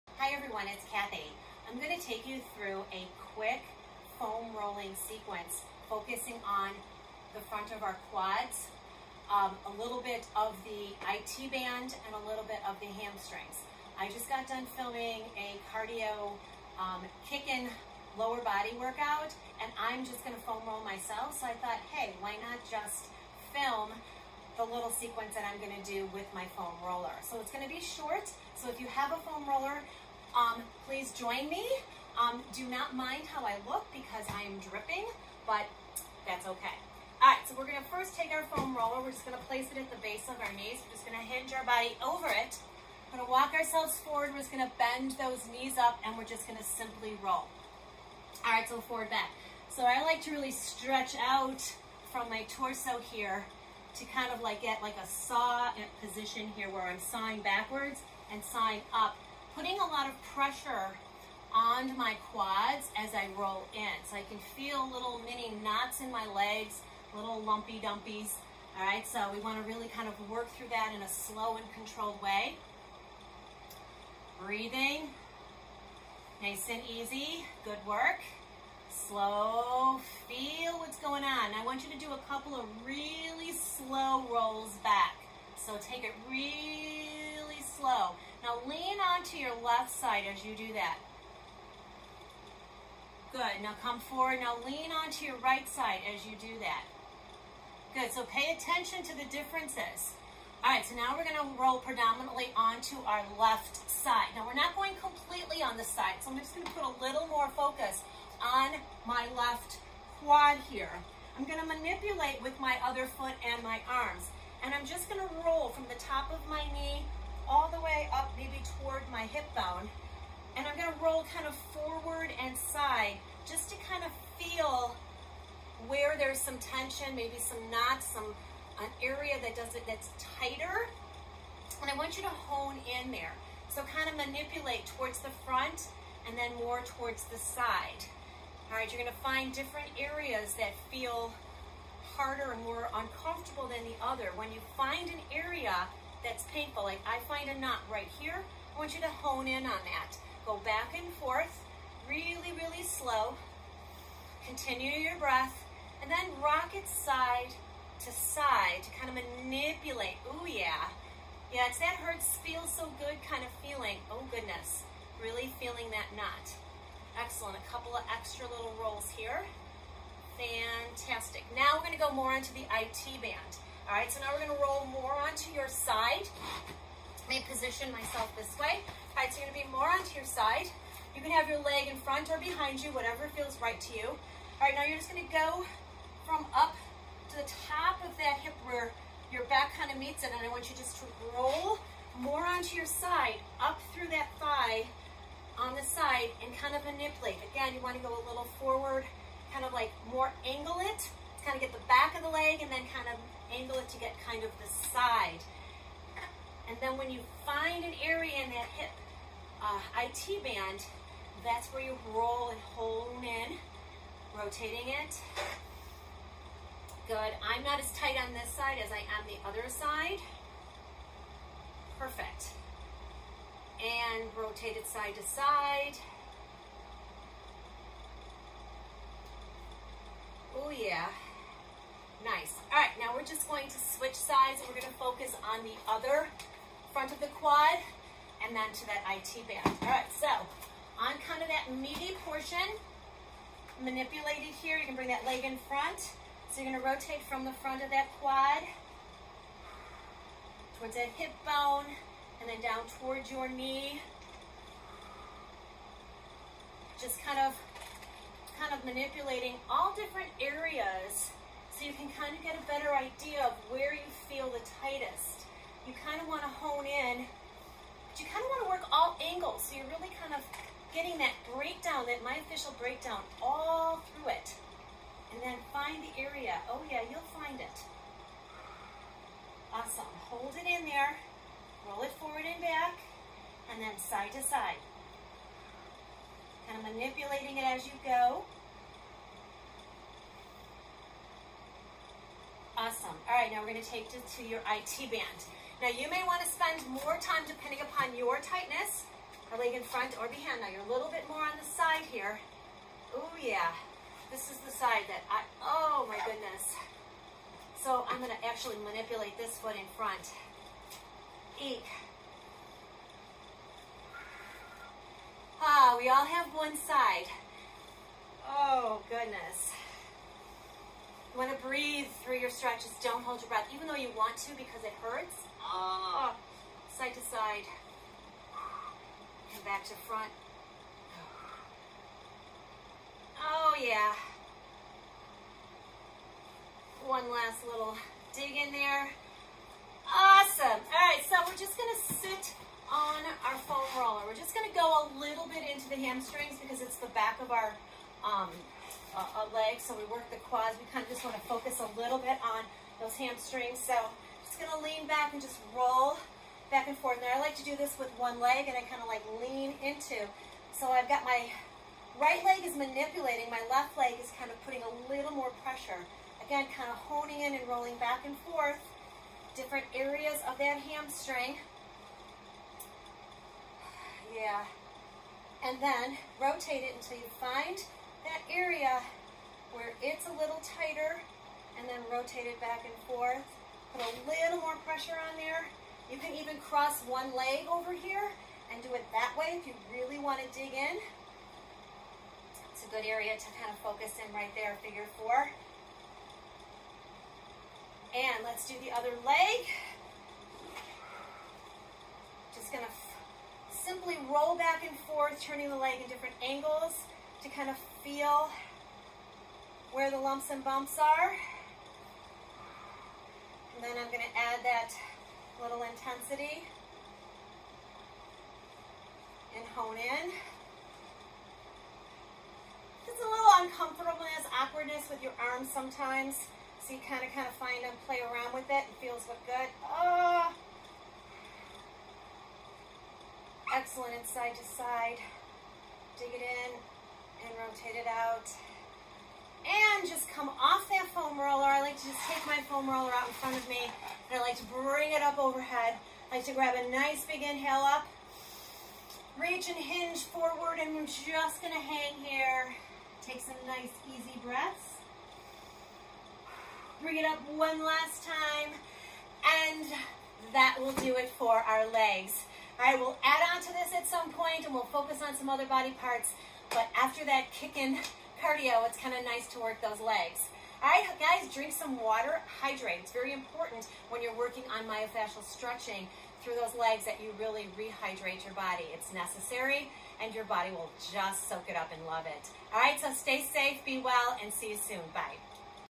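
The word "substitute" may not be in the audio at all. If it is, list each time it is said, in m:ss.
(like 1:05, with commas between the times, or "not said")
not said.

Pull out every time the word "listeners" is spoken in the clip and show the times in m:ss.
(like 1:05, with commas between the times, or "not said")
not said.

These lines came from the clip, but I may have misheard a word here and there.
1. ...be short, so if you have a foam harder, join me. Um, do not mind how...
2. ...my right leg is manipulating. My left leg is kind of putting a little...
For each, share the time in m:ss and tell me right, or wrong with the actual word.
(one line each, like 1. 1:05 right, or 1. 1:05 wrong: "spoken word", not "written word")
1. 0:27 wrong: "roller", not "harder"
2. 6:01 right.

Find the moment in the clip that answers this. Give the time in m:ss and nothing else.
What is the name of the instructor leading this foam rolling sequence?
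0:00.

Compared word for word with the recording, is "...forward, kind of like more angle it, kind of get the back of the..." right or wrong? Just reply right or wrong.
right.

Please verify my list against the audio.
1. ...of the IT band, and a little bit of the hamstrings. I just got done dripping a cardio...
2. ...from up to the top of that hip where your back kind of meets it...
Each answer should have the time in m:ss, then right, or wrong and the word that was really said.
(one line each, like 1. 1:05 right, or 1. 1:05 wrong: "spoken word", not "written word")
1. 0:10 wrong: "filming", not "dripping"
2. 3:06 right.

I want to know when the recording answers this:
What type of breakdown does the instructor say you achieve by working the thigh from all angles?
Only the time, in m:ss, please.
4:32.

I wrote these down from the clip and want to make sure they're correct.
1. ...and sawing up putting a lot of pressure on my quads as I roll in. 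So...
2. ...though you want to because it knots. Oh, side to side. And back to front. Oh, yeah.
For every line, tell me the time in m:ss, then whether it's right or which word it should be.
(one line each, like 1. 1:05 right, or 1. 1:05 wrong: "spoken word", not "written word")
1. 0:58 right
2. 5:23 wrong: "hurts", not "knots".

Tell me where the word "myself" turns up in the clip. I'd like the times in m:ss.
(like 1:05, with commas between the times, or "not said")
0:20, 2:57.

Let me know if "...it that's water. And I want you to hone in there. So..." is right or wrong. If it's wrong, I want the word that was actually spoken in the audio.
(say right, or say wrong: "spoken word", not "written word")
wrong: "tighter", not "water".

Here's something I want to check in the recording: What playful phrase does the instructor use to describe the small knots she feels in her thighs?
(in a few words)
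little lumpy dumpies.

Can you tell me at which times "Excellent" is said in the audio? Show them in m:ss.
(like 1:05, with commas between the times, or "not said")
2:47, 7:13.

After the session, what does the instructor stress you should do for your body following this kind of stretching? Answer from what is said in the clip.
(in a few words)
rehydrate.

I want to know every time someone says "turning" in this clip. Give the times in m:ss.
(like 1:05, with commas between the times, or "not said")
6:45.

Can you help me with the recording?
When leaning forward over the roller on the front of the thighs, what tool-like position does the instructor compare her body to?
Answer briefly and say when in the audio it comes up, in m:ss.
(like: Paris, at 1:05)
saw position, at 0:55.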